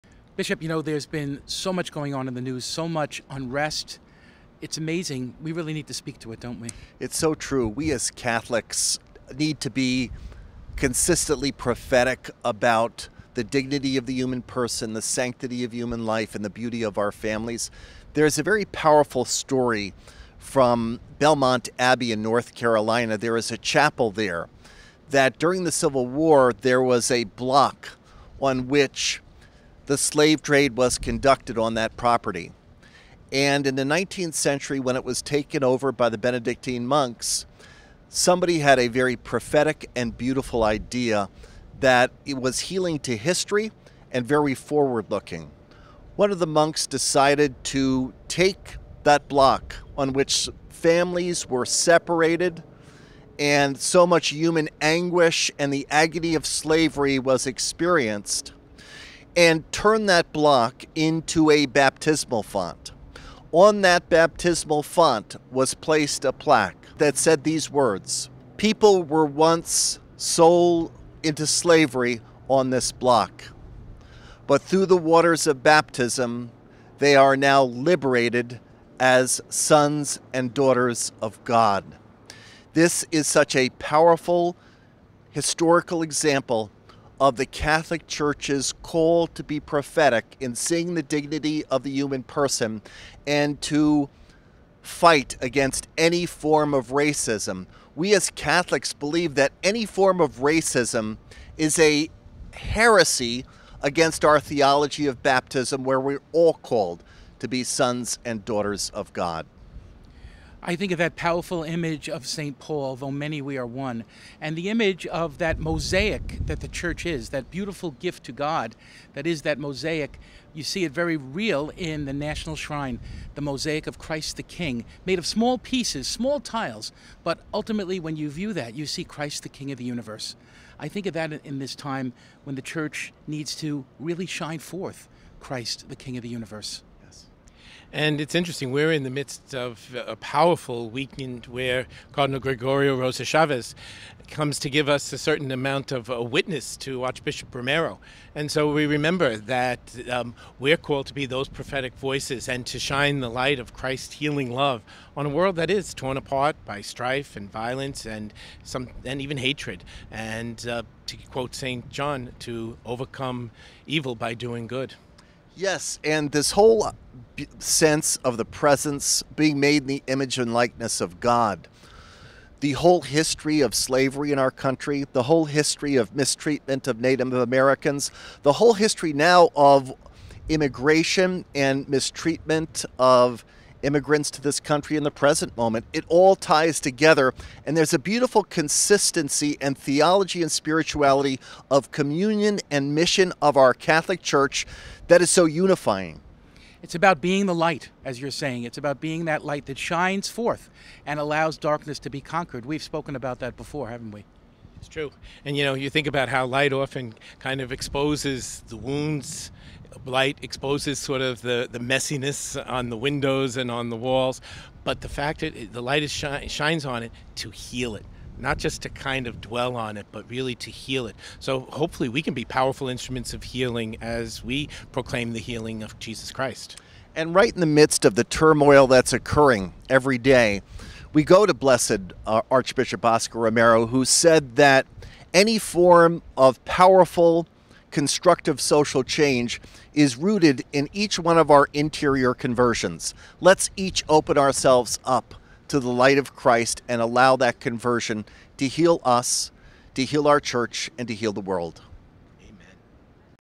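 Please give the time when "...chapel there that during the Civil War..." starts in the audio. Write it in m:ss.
0:23.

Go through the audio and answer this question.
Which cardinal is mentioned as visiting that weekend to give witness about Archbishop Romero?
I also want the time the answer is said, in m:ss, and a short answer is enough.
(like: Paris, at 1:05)
Gregorio Rosa Chavez, at 2:22.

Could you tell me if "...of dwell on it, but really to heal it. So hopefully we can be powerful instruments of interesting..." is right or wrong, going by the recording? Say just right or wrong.
wrong.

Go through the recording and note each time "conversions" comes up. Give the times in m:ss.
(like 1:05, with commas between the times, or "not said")
4:02, 4:07.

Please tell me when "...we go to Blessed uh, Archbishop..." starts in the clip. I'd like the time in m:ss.
3:51.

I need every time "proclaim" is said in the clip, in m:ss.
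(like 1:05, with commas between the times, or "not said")
3:44.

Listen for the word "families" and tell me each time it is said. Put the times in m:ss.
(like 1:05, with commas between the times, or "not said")
0:17, 0:50.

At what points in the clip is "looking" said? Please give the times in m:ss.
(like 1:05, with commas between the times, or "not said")
0:45.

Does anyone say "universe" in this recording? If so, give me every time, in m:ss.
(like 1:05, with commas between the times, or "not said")
2:09, 2:16.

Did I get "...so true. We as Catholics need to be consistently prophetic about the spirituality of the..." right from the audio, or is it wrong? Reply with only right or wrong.
wrong.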